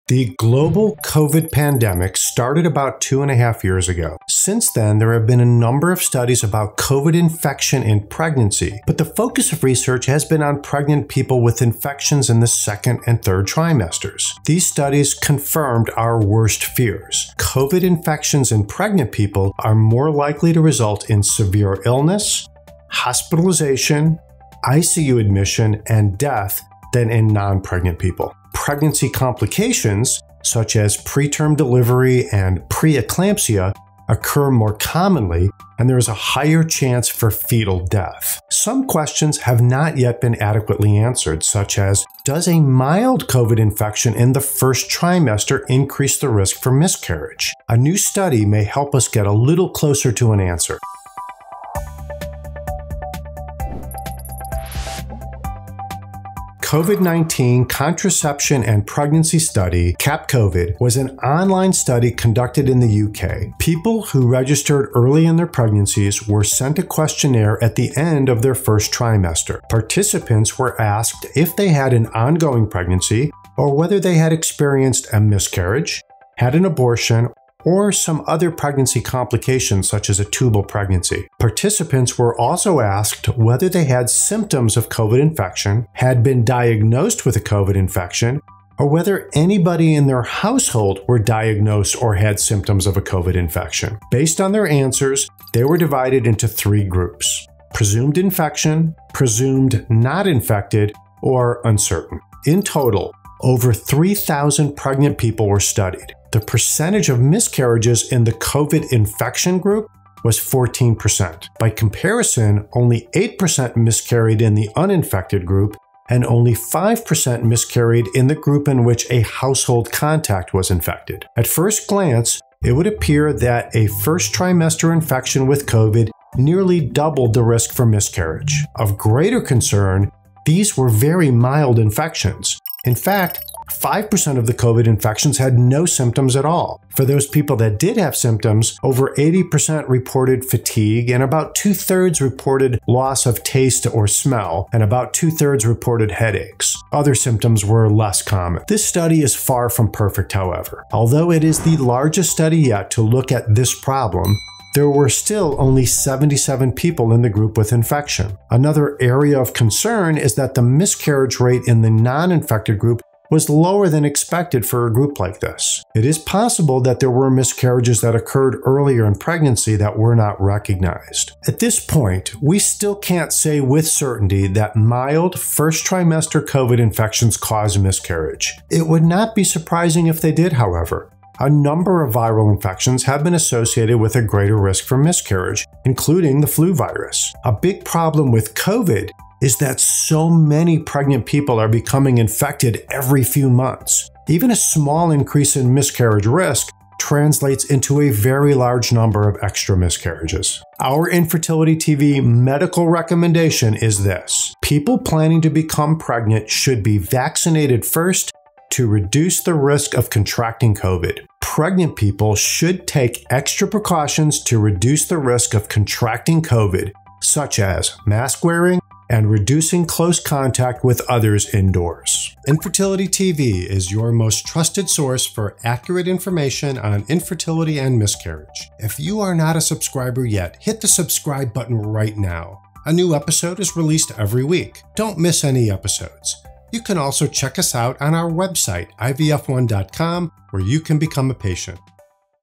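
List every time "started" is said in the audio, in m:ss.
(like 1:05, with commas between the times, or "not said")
0:02.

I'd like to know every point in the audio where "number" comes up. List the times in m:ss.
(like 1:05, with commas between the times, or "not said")
0:05, 3:01, 3:18.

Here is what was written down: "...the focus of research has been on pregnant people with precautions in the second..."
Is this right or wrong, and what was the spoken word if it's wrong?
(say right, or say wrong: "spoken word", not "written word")
wrong: "infections", not "precautions".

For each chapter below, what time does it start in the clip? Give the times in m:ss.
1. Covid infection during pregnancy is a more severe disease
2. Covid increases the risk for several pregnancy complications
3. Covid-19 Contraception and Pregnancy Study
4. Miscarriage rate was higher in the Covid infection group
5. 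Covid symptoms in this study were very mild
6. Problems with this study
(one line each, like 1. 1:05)
1. 0:17
2. 0:28
3. 0:56
4. 1:48
5. 2:09
6. 2:30.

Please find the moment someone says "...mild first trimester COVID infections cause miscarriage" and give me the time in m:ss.
2:54.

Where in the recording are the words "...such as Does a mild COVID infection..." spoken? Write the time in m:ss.
0:41.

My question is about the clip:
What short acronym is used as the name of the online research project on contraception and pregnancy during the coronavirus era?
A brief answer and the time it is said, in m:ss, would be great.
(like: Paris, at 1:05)
CAPCOVID, at 0:59.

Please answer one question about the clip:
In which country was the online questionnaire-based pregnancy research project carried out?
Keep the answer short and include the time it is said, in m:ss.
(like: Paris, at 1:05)
UK, at 1:03.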